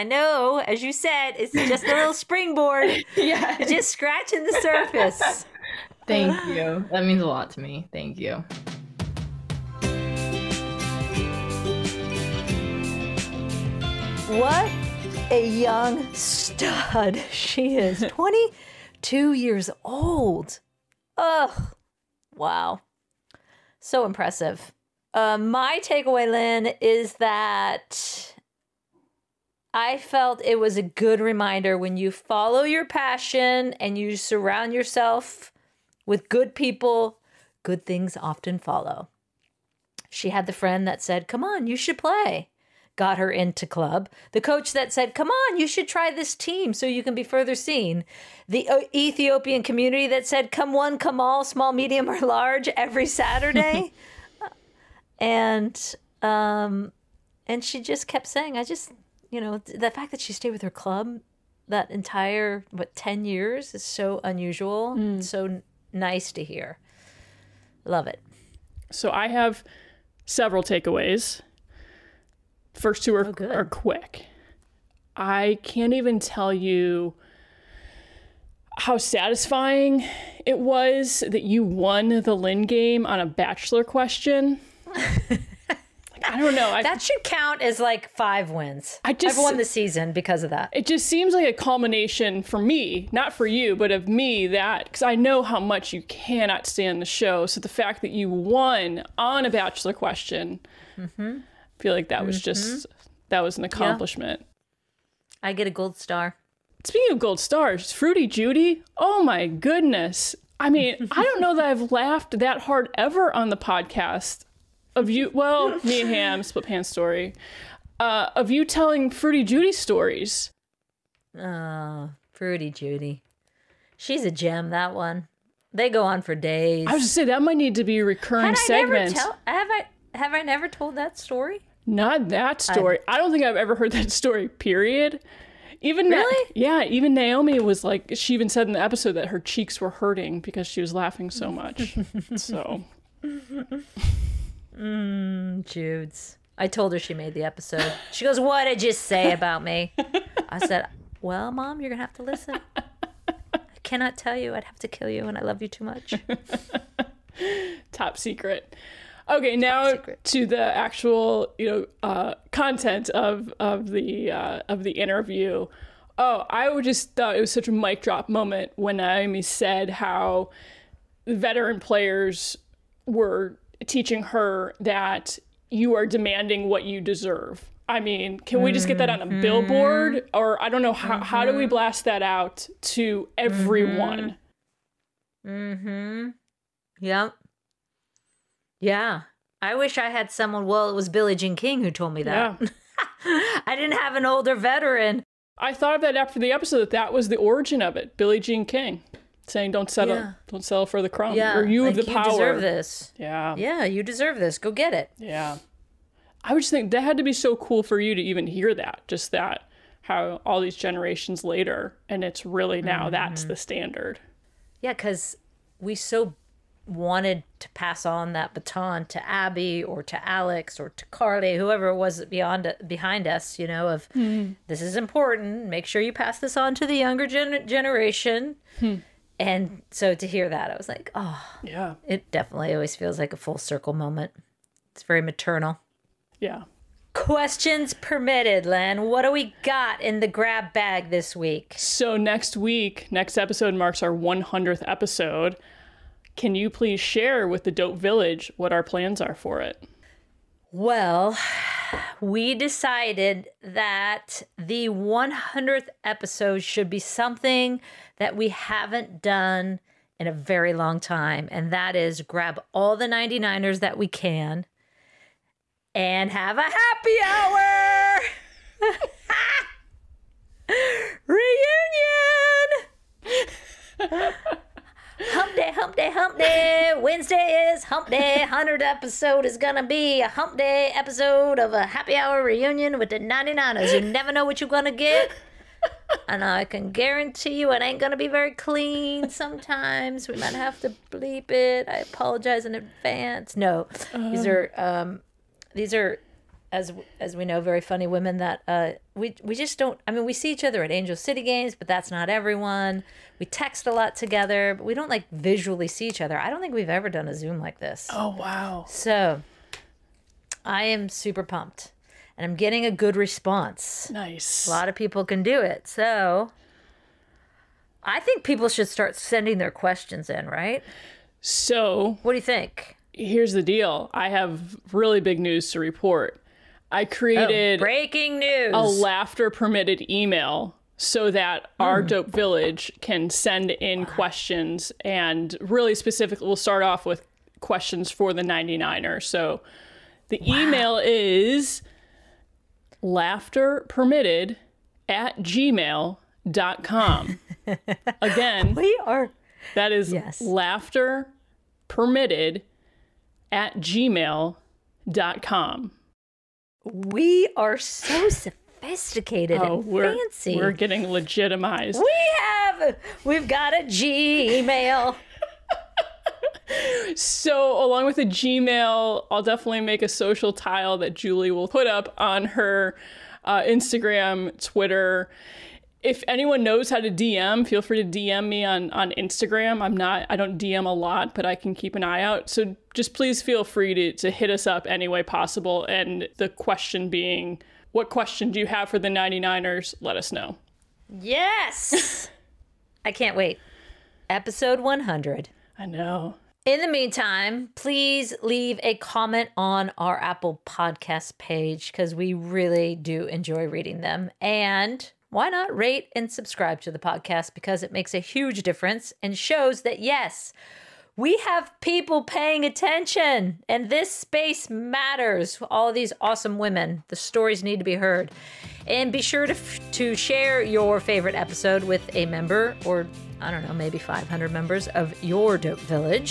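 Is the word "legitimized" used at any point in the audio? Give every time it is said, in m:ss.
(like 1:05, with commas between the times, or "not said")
6:01.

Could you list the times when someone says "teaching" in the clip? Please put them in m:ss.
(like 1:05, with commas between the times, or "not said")
2:53.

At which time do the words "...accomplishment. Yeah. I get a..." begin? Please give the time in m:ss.
1:43.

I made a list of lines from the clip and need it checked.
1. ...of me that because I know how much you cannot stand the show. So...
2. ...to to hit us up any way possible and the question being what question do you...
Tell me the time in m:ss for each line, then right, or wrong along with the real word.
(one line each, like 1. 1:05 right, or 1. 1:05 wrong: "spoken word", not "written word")
1. 1:33 right
2. 6:23 right.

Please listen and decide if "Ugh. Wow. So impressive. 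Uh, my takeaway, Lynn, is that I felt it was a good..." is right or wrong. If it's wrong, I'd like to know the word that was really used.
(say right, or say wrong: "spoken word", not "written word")
right.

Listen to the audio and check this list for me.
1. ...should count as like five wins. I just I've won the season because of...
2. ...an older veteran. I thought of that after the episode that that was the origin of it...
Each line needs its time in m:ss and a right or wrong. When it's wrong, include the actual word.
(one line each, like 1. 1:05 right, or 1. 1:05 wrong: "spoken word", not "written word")
1. 1:27 right
2. 3:14 right.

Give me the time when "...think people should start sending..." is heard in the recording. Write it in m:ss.
5:18.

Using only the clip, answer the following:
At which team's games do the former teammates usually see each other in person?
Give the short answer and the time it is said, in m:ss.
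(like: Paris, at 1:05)
Angel City, at 5:00.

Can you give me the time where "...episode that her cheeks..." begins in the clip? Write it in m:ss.
2:18.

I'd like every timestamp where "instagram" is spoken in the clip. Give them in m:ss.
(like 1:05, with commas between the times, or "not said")
6:13, 6:19.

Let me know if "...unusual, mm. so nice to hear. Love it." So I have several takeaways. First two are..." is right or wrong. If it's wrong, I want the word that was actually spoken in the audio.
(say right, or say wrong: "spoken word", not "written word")
right.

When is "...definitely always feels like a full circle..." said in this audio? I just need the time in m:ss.
3:52.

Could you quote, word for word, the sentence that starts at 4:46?
And I can guarantee you it ain't going to be very clean sometimes.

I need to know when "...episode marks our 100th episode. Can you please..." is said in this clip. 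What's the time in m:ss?
4:03.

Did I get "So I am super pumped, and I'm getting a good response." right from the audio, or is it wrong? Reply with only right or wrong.
right.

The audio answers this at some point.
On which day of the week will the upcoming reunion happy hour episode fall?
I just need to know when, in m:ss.
4:36.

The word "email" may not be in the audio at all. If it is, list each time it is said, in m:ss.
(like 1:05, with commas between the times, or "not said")
5:30, 5:40.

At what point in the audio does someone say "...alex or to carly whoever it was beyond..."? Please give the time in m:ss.
3:40.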